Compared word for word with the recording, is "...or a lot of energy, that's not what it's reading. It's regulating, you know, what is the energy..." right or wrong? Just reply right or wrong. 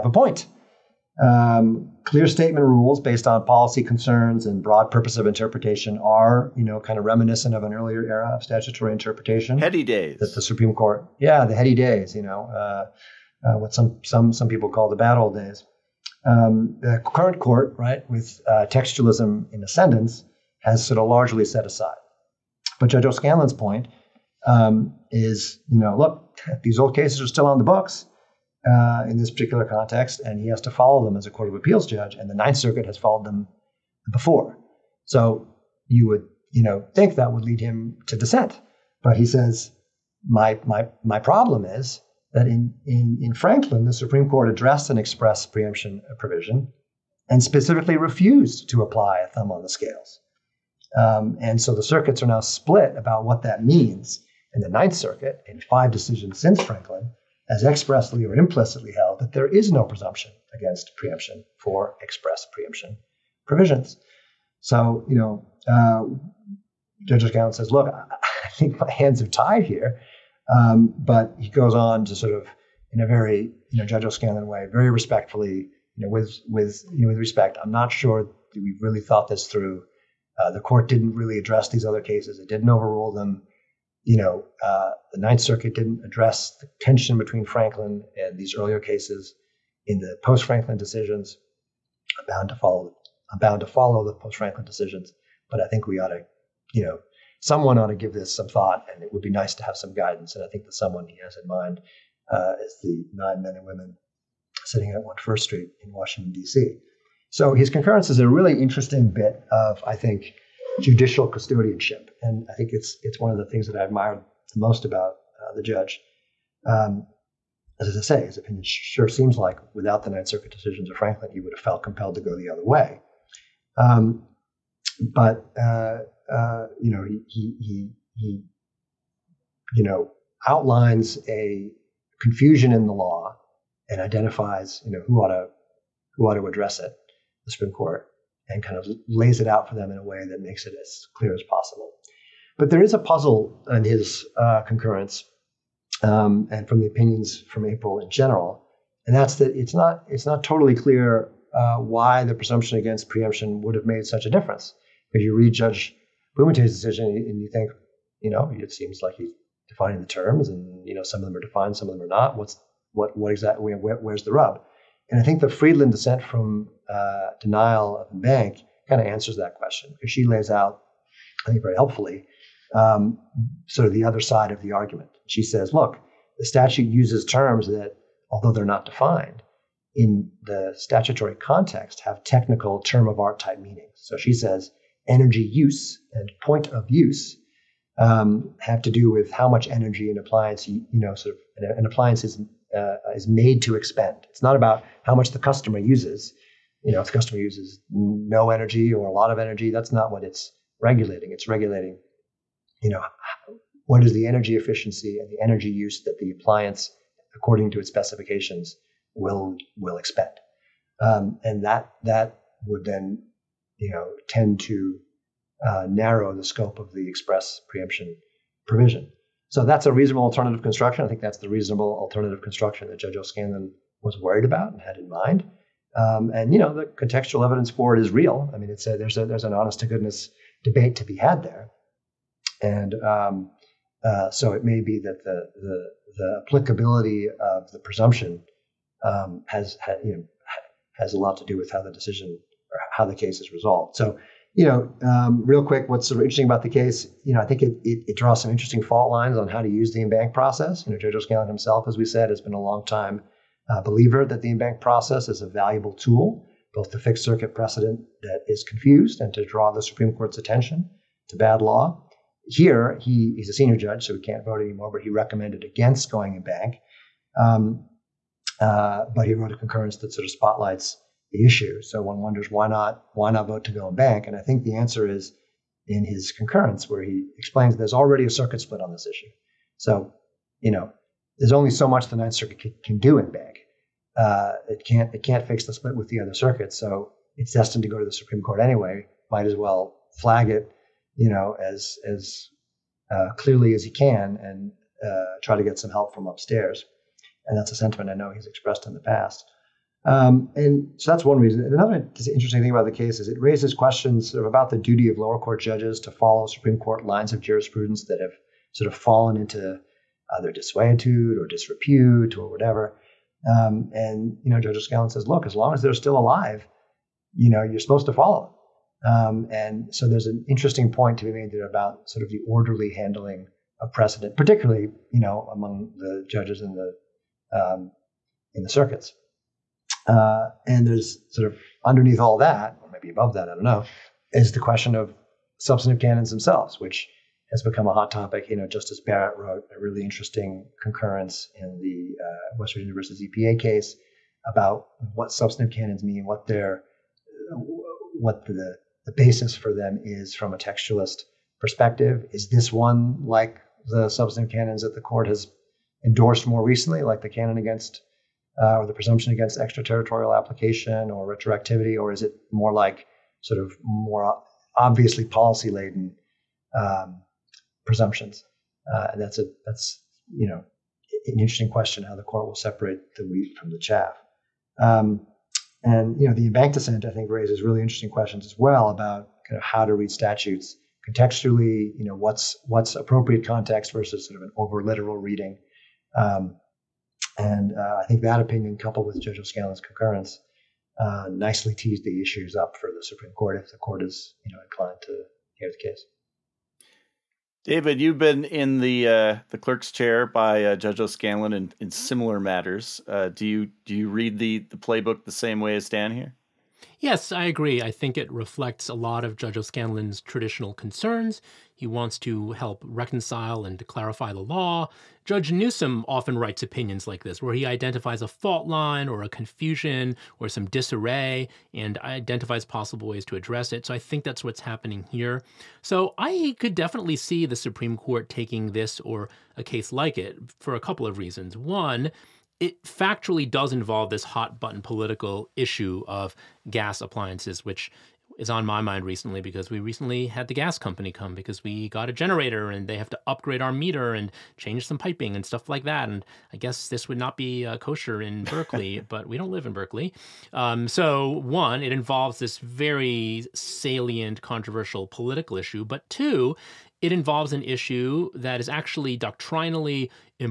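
wrong.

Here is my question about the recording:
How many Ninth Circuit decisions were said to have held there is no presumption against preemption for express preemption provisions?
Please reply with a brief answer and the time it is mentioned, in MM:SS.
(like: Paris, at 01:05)
5, at 00:55.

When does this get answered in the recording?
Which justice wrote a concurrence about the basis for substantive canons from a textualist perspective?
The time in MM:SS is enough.
05:38.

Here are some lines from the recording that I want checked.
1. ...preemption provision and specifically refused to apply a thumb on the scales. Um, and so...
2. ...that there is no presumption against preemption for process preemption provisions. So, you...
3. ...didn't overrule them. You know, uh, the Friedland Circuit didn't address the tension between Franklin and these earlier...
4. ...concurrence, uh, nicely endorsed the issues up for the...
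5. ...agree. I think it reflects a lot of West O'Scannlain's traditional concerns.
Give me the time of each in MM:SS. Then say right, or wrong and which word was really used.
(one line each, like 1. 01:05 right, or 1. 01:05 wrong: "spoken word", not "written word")
1. 00:45 right
2. 00:59 wrong: "express", not "process"
3. 01:22 wrong: "Ninth", not "Friedland"
4. 06:29 wrong: "teased", not "endorsed"
5. 06:47 wrong: "Judge", not "West".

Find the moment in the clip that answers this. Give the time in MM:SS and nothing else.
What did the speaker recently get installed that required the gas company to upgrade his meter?
07:22.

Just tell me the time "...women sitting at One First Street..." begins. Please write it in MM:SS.
01:43.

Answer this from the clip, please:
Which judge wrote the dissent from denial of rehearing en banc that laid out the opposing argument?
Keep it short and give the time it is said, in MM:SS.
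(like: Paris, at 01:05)
Friedland, at 02:45.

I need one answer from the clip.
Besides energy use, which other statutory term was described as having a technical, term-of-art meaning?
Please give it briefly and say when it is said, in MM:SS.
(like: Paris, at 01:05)
point of use, at 03:06.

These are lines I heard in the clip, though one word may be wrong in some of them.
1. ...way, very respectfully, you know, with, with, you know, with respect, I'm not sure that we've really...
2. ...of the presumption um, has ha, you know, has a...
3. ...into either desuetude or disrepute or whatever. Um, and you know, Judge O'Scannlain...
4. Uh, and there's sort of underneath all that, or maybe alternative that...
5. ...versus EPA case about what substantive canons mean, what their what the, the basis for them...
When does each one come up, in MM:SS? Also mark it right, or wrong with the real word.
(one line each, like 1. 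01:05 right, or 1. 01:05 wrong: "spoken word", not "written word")
1. 01:14 right
2. 03:57 right
3. 05:09 right
4. 05:30 wrong: "above", not "alternative"
5. 05:42 right.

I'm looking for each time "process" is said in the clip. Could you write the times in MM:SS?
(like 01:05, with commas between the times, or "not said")
04:10, 04:14.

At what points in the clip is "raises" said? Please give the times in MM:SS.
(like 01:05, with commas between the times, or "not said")
05:03, 06:17.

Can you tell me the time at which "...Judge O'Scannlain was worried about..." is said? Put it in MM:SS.
03:42.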